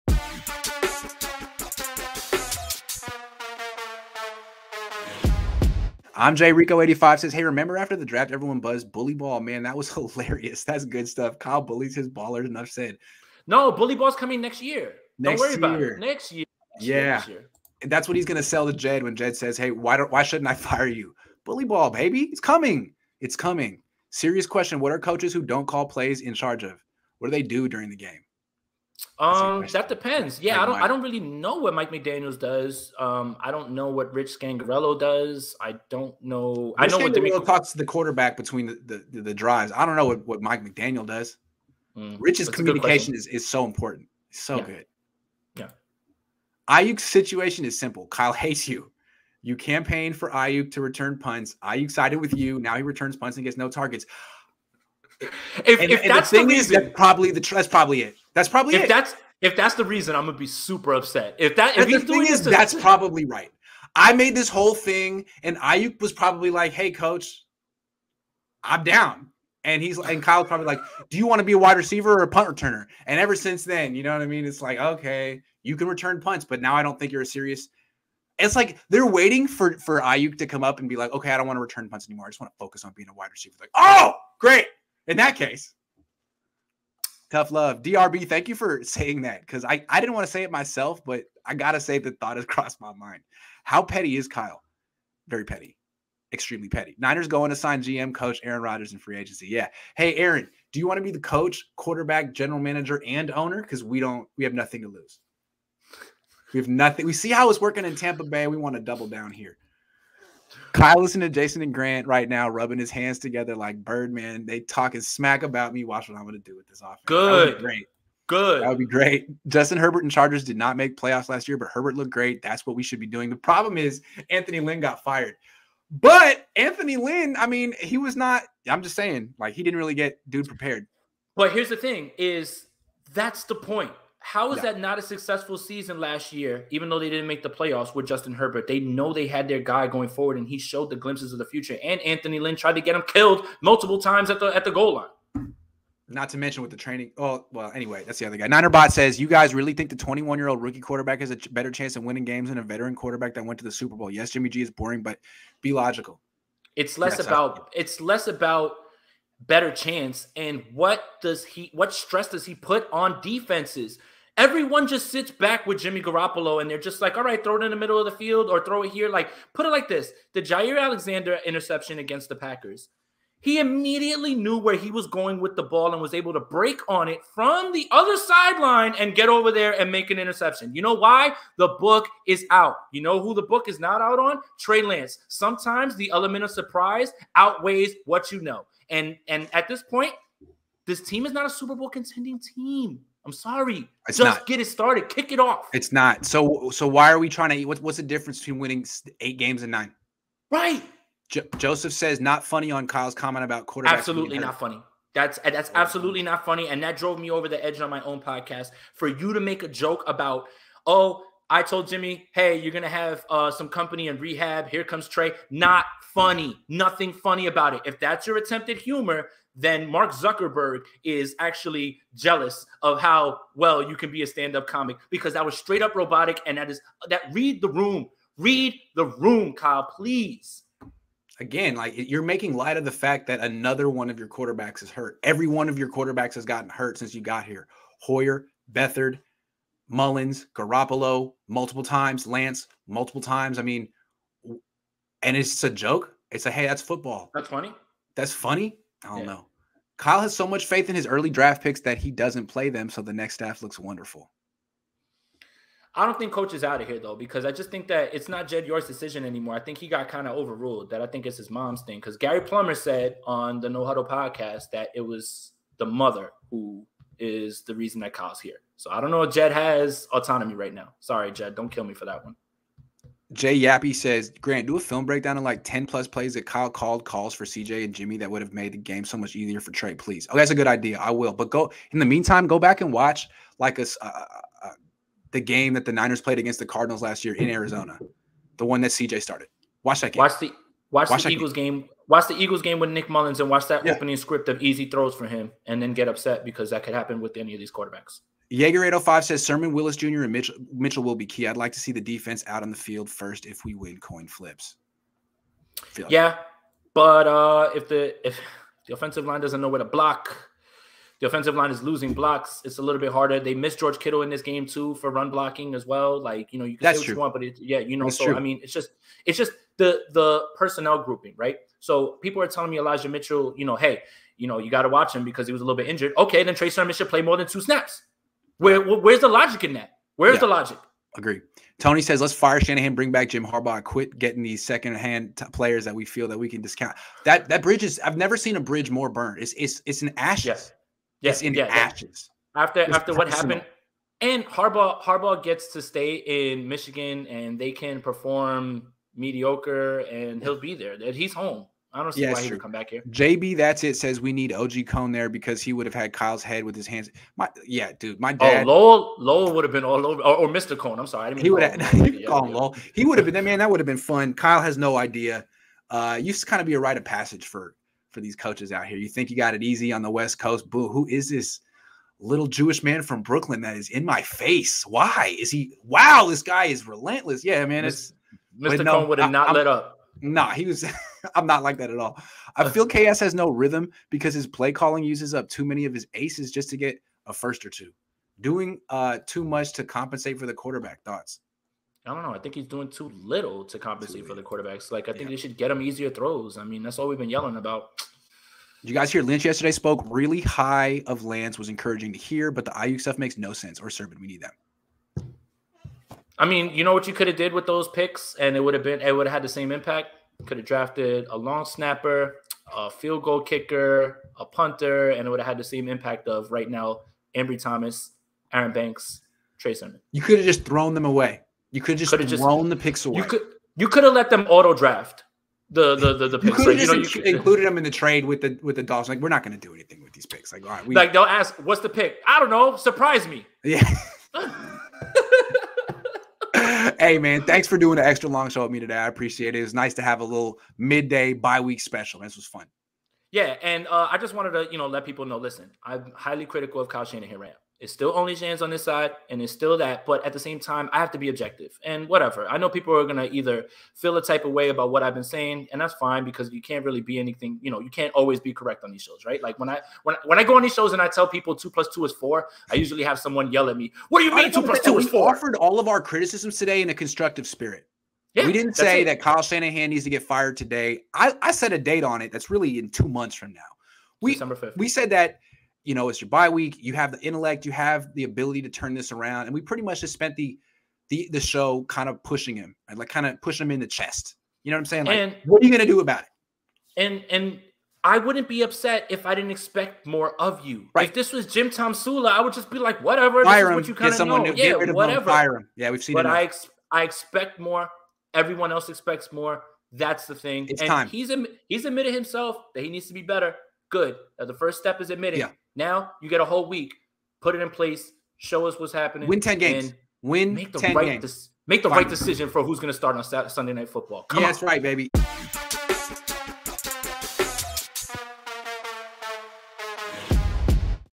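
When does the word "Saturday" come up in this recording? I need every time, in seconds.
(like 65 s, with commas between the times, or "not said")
513 s.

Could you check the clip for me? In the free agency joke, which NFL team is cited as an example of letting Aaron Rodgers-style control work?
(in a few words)
Tampa Bay.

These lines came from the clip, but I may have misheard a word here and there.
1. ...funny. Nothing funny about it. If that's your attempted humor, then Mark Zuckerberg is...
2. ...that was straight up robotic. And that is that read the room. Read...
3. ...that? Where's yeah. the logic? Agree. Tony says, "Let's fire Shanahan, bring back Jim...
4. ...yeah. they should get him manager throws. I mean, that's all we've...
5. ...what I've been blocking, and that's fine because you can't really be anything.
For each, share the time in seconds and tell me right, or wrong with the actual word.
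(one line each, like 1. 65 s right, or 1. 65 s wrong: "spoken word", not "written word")
1. 216 s right
2. 225 s right
3. 329 s right
4. 395 s wrong: "easier", not "manager"
5. 454 s wrong: "saying", not "blocking".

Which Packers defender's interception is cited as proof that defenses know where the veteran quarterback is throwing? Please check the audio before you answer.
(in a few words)
Jaire Alexander.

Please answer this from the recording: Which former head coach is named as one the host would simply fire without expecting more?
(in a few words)
Jim Tomsula.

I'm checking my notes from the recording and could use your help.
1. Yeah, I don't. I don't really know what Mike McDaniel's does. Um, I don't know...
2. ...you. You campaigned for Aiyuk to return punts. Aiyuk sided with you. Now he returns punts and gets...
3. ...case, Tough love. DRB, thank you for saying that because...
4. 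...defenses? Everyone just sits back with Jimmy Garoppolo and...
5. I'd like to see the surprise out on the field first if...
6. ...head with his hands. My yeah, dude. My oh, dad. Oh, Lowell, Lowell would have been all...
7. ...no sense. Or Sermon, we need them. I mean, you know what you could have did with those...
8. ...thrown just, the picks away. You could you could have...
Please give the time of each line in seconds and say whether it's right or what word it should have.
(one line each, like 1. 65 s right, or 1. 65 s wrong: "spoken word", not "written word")
1. 30 s right
2. 48 s right
3. 85 s right
4. 163 s right
5. 301 s wrong: "defense", not "surprise"
6. 356 s right
7. 403 s right
8. 422 s right.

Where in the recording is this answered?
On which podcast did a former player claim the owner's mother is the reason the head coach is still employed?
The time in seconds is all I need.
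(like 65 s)
263 s.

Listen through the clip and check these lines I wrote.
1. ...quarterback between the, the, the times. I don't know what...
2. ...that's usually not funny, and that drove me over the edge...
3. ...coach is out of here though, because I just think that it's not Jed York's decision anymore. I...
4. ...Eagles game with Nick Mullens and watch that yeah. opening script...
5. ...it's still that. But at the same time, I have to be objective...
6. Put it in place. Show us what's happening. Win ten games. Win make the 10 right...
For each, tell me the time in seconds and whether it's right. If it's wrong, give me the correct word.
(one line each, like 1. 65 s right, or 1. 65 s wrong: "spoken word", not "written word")
1. 37 s wrong: "drives", not "times"
2. 205 s wrong: "absolutely", not "usually"
3. 256 s right
4. 292 s right
5. 449 s right
6. 507 s right.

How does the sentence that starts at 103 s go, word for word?
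Because we don't, we have nothing to lose.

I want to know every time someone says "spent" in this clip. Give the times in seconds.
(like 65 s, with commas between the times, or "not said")
480 s.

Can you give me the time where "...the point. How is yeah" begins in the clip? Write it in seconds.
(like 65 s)
133 s.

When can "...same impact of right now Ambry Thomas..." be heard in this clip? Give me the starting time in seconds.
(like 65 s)
415 s.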